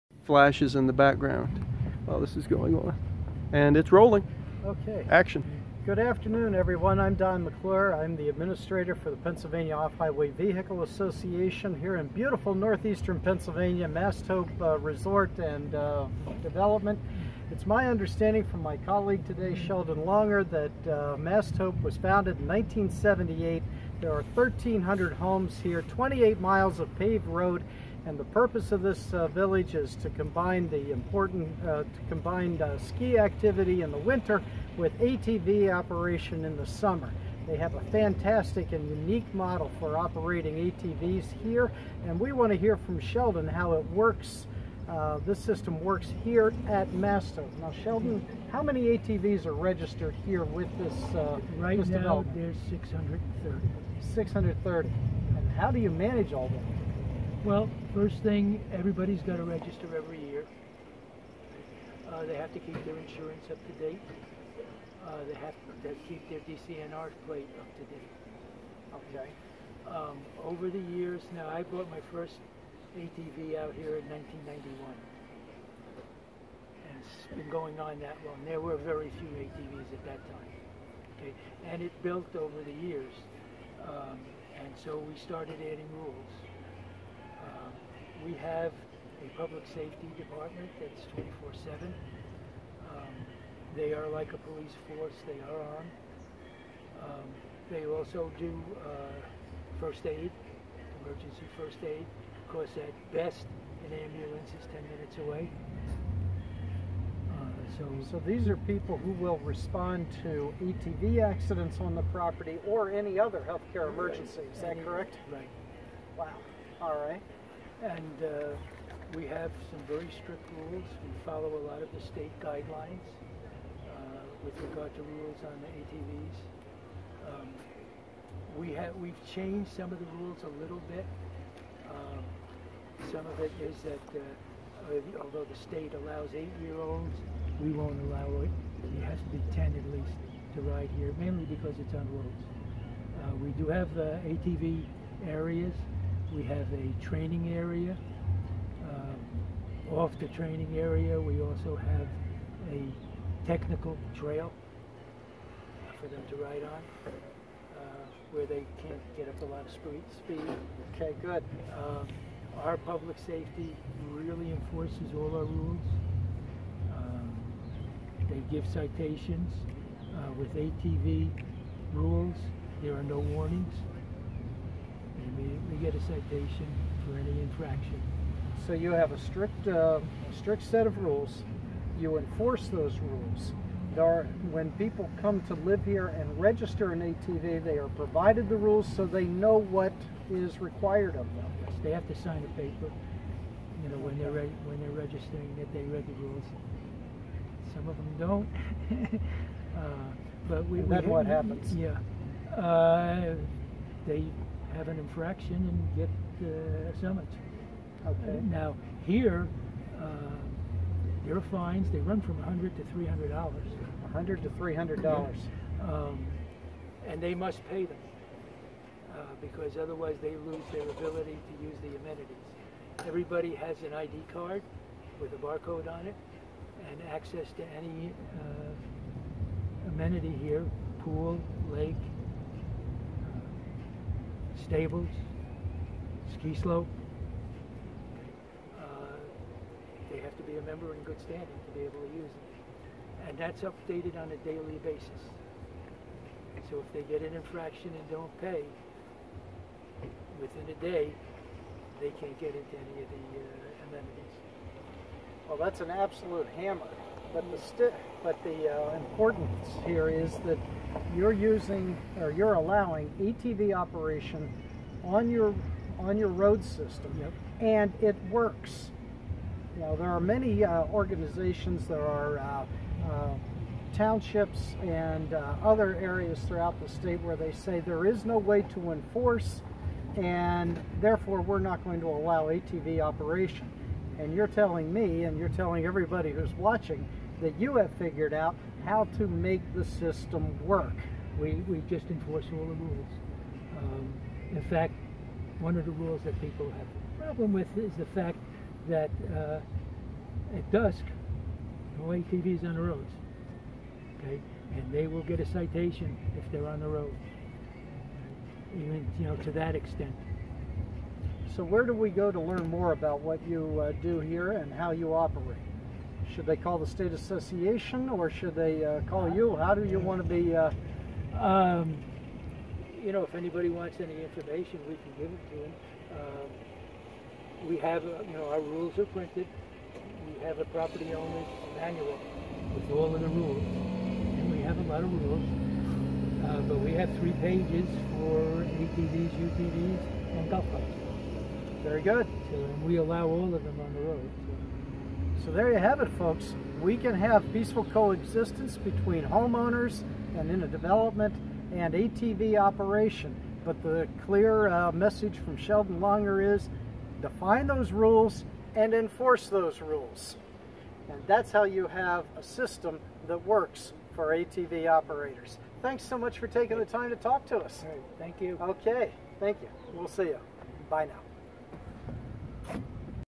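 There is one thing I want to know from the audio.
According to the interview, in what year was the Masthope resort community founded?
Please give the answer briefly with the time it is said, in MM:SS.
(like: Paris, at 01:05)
1978, at 00:22.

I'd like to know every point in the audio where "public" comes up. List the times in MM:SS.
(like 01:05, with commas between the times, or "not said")
01:29, 02:42.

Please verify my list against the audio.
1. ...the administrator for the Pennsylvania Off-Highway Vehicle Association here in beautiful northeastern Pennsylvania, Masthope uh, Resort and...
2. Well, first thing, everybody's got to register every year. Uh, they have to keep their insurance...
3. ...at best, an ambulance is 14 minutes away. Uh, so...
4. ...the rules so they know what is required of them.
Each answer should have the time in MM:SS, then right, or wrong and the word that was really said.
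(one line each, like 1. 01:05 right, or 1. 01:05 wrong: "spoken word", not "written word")
1. 00:08 right
2. 00:57 right
3. 01:42 wrong: "10", not "14"
4. 03:08 right.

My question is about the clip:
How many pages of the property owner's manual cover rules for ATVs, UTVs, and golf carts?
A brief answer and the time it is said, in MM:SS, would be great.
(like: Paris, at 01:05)
3, at 05:37.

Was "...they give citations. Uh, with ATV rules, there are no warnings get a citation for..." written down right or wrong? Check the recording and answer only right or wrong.
right.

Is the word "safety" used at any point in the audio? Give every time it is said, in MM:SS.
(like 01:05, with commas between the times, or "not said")
01:29, 02:43.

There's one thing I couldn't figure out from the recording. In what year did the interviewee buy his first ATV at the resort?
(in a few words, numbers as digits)
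1991.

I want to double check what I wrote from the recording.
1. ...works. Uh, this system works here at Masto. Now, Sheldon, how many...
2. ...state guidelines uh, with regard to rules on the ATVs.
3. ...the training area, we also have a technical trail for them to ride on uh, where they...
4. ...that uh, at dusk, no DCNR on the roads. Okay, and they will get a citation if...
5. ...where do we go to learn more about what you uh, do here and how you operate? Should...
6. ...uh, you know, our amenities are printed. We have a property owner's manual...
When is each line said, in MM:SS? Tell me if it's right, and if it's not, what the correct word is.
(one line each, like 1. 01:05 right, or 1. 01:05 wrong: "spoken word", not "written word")
1. 00:43 right
2. 02:02 right
3. 02:30 right
4. 04:58 wrong: "ATVs", not "DCNR"
5. 05:11 right
6. 05:28 wrong: "rules", not "amenities".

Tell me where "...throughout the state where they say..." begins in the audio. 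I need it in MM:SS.
04:36.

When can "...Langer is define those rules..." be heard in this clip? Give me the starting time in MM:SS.
05:55.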